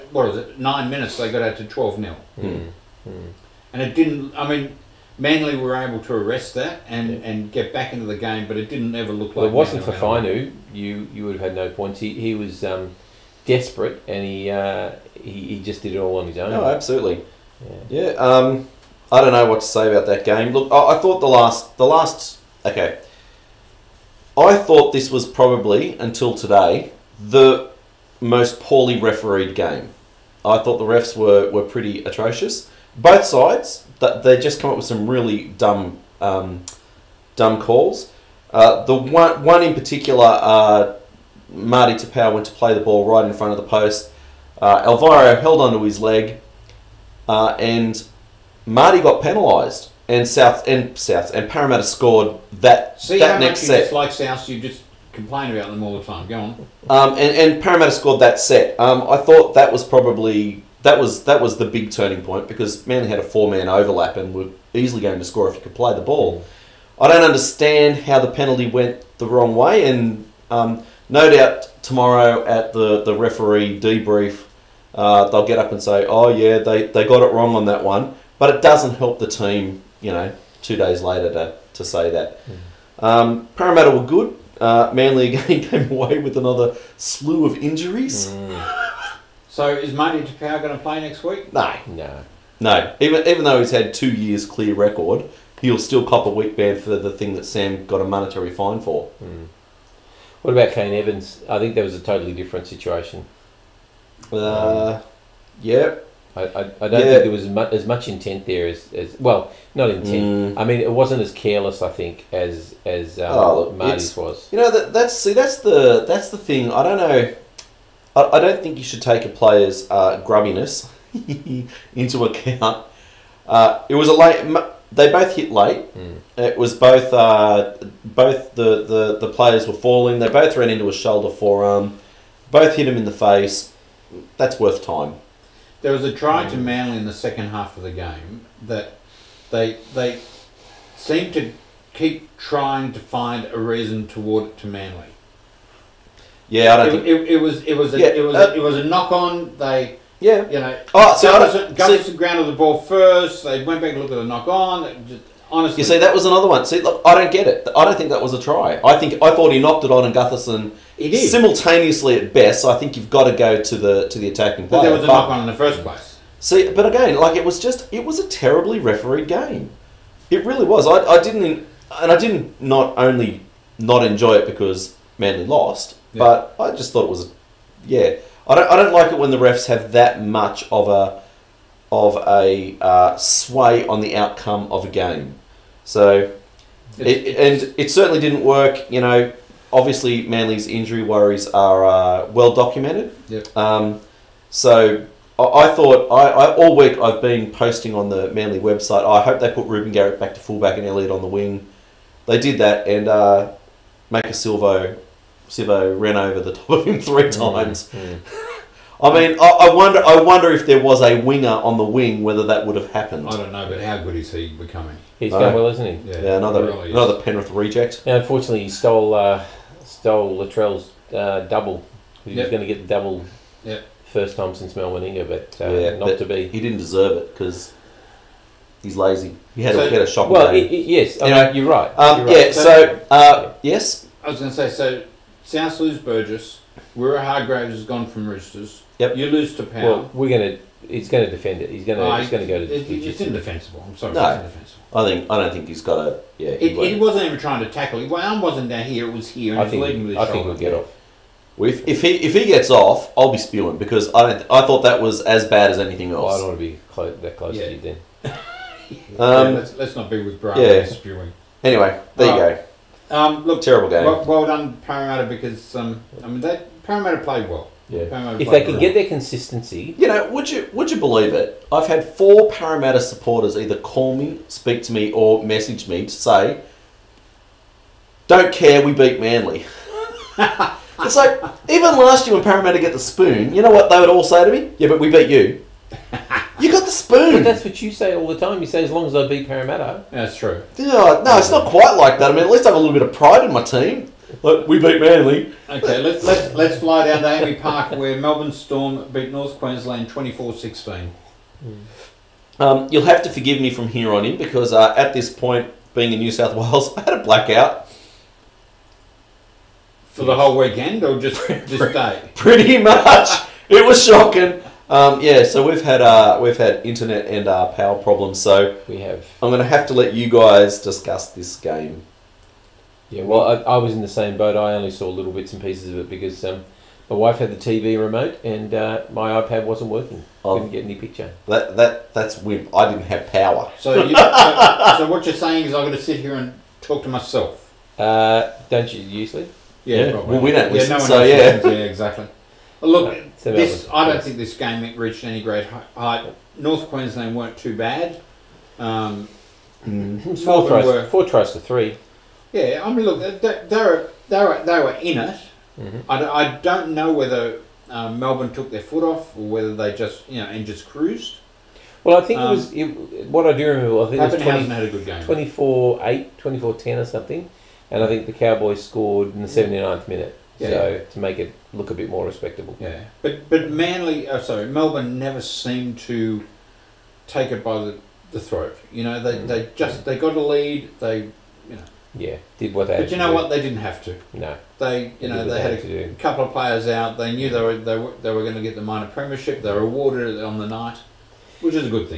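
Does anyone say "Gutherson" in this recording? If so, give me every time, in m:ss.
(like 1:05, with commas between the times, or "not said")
2:31, 2:40.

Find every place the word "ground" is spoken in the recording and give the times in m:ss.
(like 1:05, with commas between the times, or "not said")
2:32.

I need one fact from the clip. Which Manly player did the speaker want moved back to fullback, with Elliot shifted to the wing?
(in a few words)
Reuben Garrick.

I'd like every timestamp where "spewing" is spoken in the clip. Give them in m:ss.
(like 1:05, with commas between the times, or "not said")
4:13, 4:20.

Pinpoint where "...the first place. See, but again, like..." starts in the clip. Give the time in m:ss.
2:45.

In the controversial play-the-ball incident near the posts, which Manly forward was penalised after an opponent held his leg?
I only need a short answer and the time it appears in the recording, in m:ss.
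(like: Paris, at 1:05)
Marty Taupau, at 0:41.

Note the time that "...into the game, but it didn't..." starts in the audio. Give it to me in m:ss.
0:07.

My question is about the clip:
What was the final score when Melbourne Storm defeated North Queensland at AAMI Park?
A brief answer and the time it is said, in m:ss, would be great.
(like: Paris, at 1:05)
24-16, at 5:00.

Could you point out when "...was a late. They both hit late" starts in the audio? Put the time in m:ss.
2:03.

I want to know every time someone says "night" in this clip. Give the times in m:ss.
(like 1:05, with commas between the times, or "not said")
6:30.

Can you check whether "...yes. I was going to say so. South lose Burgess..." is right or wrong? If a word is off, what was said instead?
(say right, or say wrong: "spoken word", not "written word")
right.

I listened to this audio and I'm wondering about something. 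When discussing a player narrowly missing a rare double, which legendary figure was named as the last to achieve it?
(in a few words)
Mal Meninga.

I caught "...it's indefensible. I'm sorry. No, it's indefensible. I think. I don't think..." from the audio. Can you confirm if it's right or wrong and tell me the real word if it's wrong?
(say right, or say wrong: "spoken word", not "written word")
right.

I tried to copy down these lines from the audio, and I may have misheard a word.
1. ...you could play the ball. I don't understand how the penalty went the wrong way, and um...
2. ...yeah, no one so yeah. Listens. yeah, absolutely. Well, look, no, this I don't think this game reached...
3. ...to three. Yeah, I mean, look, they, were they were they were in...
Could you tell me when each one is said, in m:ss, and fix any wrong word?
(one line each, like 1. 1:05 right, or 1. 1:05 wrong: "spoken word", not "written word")
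1. 1:05 right
2. 5:40 wrong: "exactly", not "absolutely"
3. 5:51 right.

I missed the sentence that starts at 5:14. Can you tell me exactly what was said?
Um, yeah, so we've had uh, we've had internet and uh, power problems.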